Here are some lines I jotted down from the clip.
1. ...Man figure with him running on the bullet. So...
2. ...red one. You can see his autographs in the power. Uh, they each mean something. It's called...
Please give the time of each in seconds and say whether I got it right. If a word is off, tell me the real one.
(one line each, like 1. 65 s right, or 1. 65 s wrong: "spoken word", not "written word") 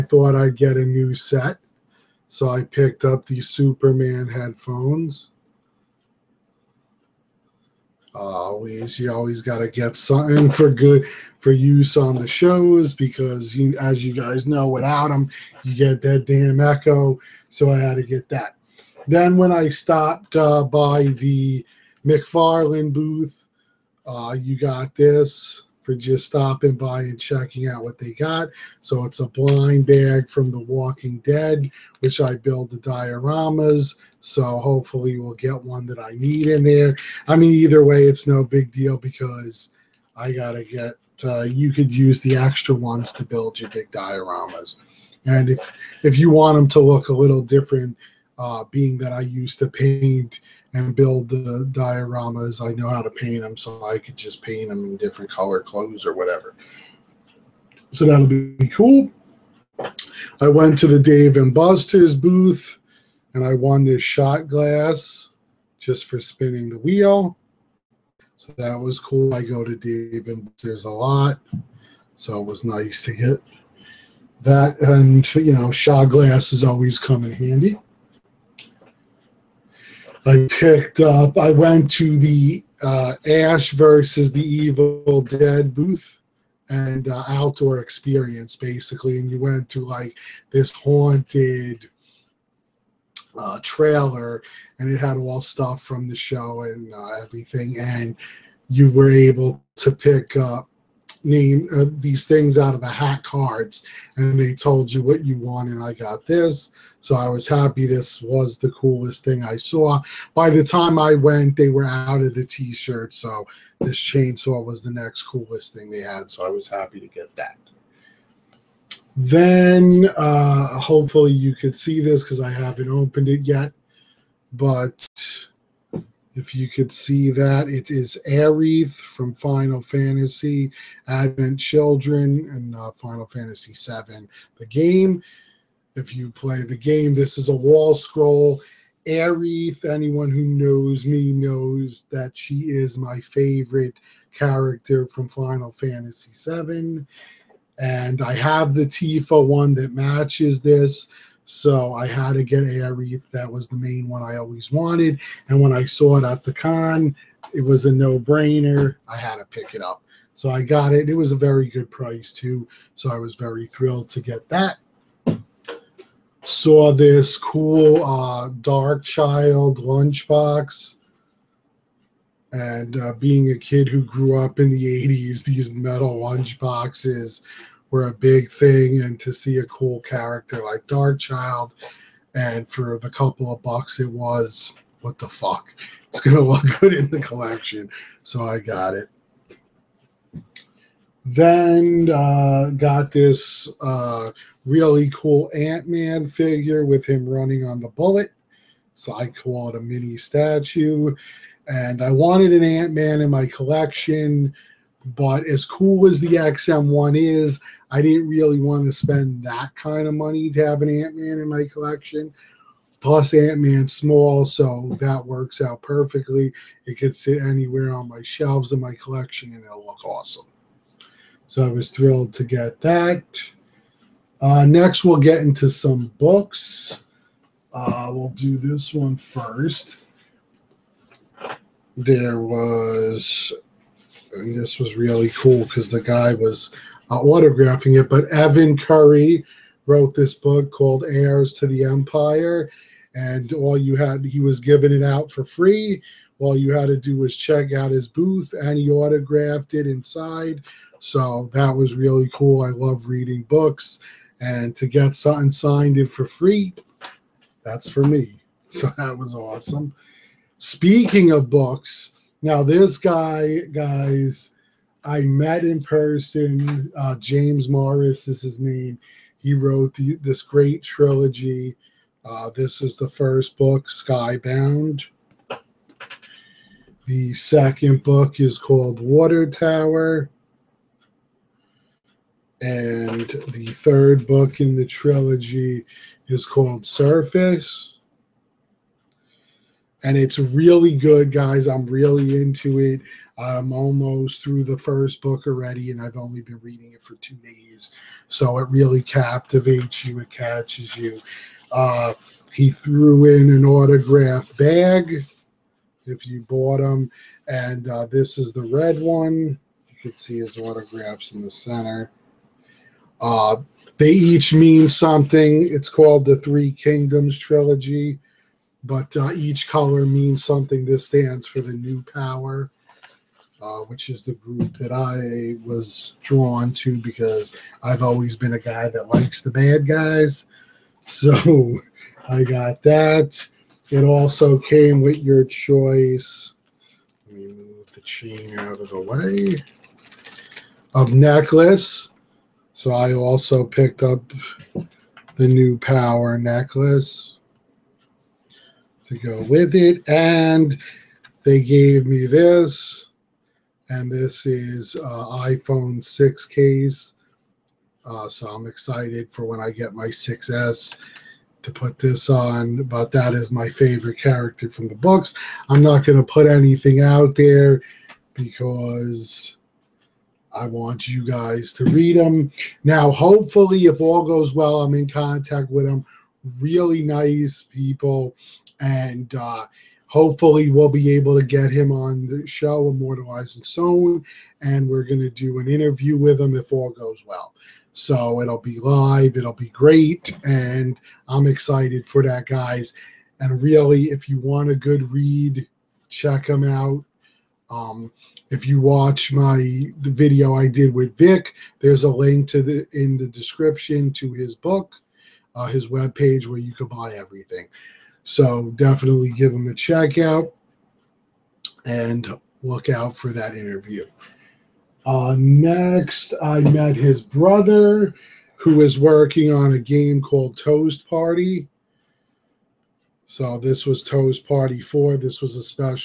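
1. 195 s right
2. 308 s wrong: "center", not "power".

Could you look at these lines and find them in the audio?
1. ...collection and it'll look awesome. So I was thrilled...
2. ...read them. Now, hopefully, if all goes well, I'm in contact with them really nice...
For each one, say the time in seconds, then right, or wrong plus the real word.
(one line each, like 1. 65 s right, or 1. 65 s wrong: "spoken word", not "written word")
1. 218 s right
2. 371 s right.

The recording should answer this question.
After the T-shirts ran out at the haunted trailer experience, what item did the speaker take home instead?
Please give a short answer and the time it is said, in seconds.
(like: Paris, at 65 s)
Chainsaw, at 113 s.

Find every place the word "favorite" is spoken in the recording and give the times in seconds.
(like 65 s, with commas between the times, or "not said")
143 s, 363 s.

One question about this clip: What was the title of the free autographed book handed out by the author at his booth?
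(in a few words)
Heirs to the Empire.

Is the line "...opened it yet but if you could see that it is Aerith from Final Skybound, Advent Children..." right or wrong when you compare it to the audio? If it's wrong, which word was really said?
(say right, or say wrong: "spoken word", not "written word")
wrong: "Fantasy", not "Skybound".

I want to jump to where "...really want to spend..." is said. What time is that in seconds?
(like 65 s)
208 s.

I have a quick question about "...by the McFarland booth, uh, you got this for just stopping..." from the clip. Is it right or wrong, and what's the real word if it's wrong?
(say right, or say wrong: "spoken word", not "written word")
right.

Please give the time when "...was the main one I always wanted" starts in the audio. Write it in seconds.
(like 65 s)
153 s.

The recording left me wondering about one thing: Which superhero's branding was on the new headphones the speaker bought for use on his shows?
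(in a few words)
Superman.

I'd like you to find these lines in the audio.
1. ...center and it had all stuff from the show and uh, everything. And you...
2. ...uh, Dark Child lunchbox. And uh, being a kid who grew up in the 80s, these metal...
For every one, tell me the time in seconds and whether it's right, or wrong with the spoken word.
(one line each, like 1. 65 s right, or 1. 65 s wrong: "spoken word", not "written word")
1. 93 s wrong: "trailer", not "center"
2. 168 s right.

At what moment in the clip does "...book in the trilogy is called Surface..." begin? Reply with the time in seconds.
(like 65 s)
284 s.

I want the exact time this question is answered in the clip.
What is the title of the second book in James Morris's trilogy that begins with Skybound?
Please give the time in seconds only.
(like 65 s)
279 s.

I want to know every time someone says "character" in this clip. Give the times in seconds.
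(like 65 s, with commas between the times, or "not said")
144 s, 180 s, 364 s.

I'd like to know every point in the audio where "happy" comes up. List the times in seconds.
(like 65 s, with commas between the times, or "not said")
107 s, 116 s.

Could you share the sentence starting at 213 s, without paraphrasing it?
Plus, Ant Man's small, so that works out perfectly.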